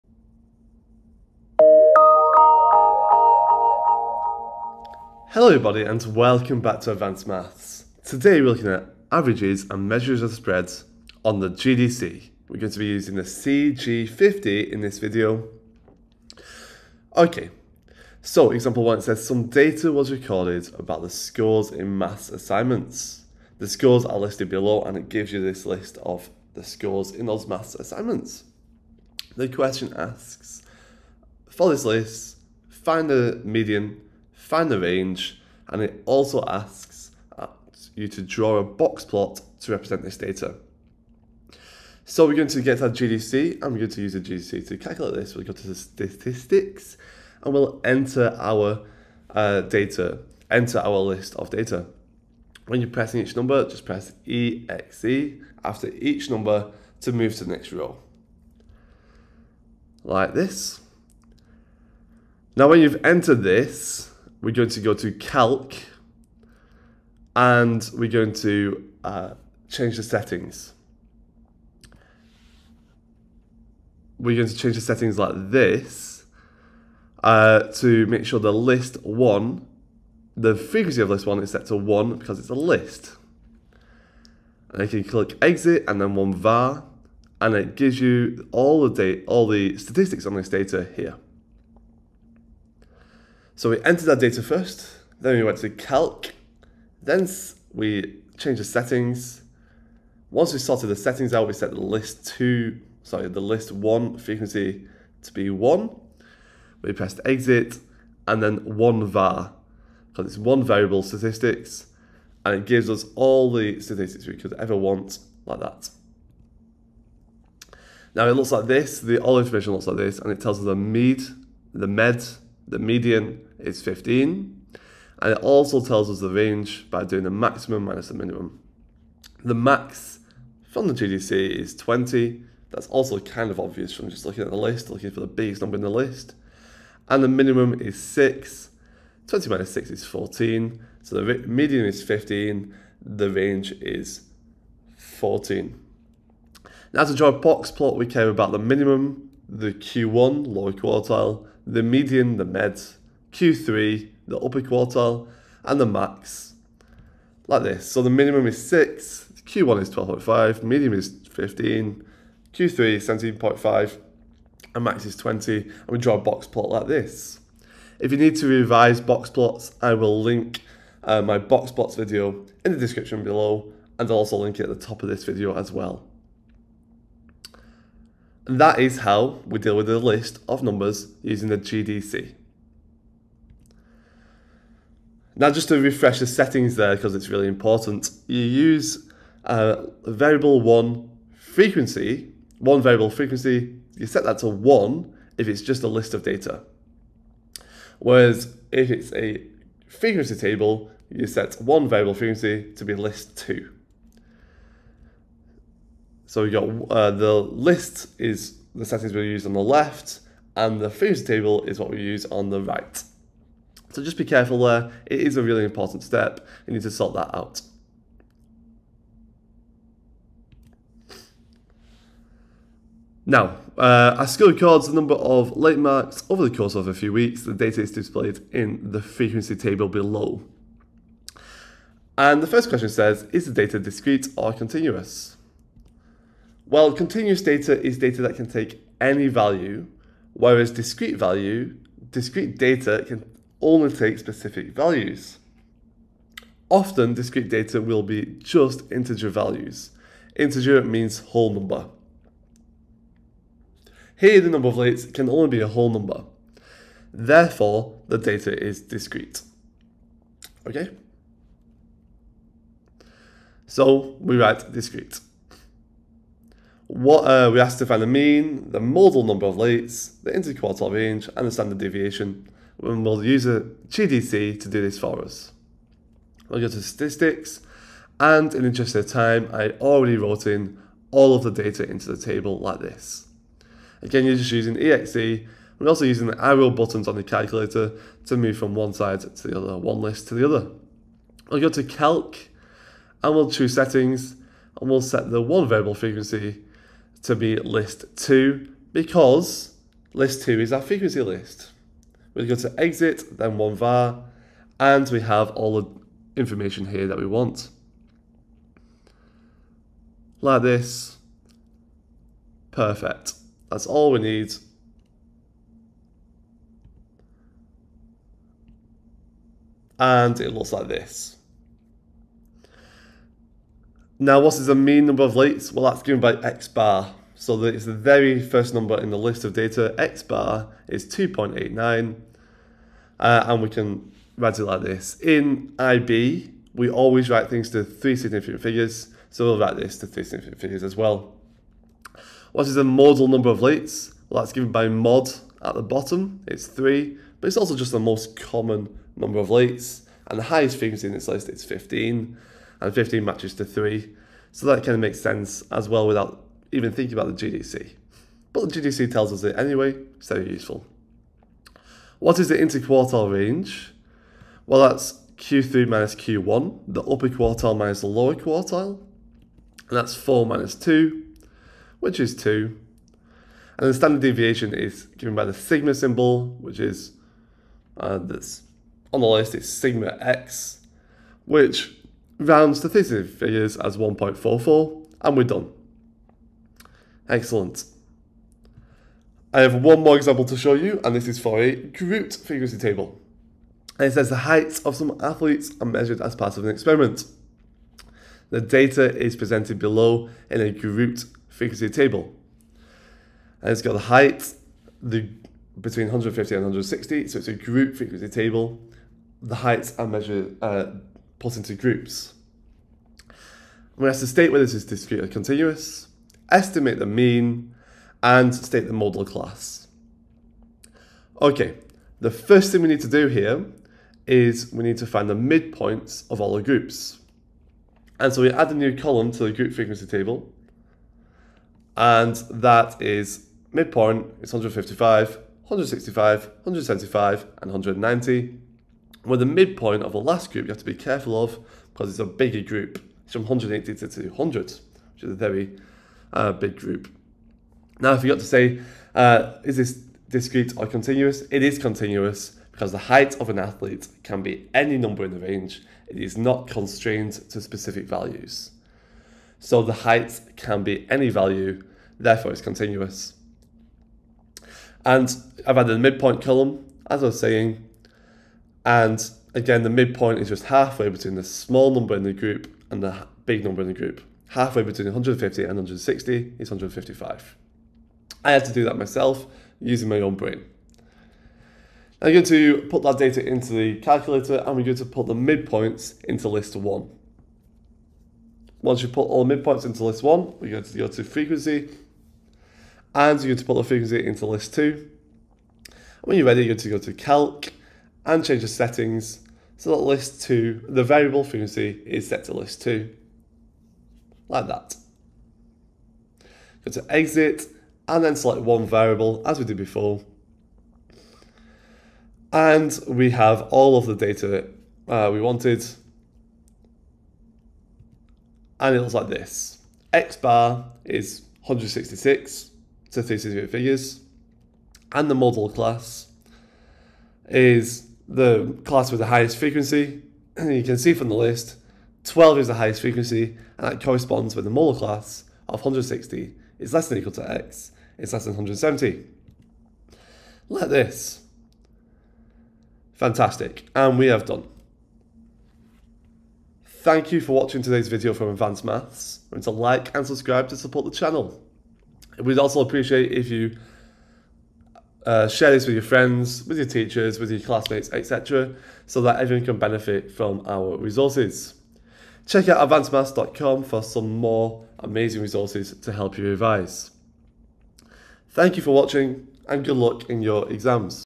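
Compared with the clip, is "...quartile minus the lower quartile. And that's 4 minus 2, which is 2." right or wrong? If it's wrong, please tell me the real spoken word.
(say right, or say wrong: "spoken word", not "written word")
right.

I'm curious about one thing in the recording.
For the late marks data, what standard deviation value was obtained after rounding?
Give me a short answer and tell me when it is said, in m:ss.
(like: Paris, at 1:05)
1.44, at 6:23.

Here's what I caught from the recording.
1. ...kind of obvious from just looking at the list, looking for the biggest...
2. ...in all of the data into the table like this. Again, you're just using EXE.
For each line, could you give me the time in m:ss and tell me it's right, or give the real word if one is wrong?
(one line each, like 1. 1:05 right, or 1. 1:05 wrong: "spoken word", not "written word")
1. 2:13 right
2. 4:40 right.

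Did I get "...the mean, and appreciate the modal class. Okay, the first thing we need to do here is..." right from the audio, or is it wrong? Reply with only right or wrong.
wrong.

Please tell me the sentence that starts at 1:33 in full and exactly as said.
So we entered our data first, then we went to calc, then we changed the settings.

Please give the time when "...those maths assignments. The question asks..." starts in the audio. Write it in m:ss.
0:27.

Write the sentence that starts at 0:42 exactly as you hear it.
So we're going to get our GDC, and we're going to use the GDC to calculate this.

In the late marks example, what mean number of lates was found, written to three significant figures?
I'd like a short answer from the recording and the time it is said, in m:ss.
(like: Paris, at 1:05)
2.89, at 5:29.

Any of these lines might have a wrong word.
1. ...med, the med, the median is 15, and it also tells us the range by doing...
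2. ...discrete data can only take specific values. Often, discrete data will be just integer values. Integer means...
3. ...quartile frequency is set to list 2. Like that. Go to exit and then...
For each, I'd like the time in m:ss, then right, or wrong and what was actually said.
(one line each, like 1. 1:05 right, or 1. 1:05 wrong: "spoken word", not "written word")
1. 2:00 right
2. 4:02 right
3. 8:21 wrong: "variable", not "quartile".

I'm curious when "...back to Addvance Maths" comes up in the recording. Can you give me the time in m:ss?
0:06.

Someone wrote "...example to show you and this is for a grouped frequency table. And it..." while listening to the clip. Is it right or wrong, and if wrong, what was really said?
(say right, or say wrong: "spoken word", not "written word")
right.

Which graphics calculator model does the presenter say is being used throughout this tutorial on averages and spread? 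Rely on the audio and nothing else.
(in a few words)
CG50.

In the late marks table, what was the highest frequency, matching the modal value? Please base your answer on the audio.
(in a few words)
15.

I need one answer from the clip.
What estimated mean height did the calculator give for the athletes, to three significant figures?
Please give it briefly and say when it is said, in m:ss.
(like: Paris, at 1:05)
166, at 8:41.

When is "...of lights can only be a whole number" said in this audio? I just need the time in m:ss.
4:14.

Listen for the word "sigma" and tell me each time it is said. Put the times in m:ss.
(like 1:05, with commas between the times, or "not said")
6:15, 6:19.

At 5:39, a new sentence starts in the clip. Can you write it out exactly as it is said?
So we'll write this to three significant figures as well.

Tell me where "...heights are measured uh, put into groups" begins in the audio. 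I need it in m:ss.
6:49.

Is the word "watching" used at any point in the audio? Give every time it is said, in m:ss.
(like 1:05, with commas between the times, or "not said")
9:07, 9:28.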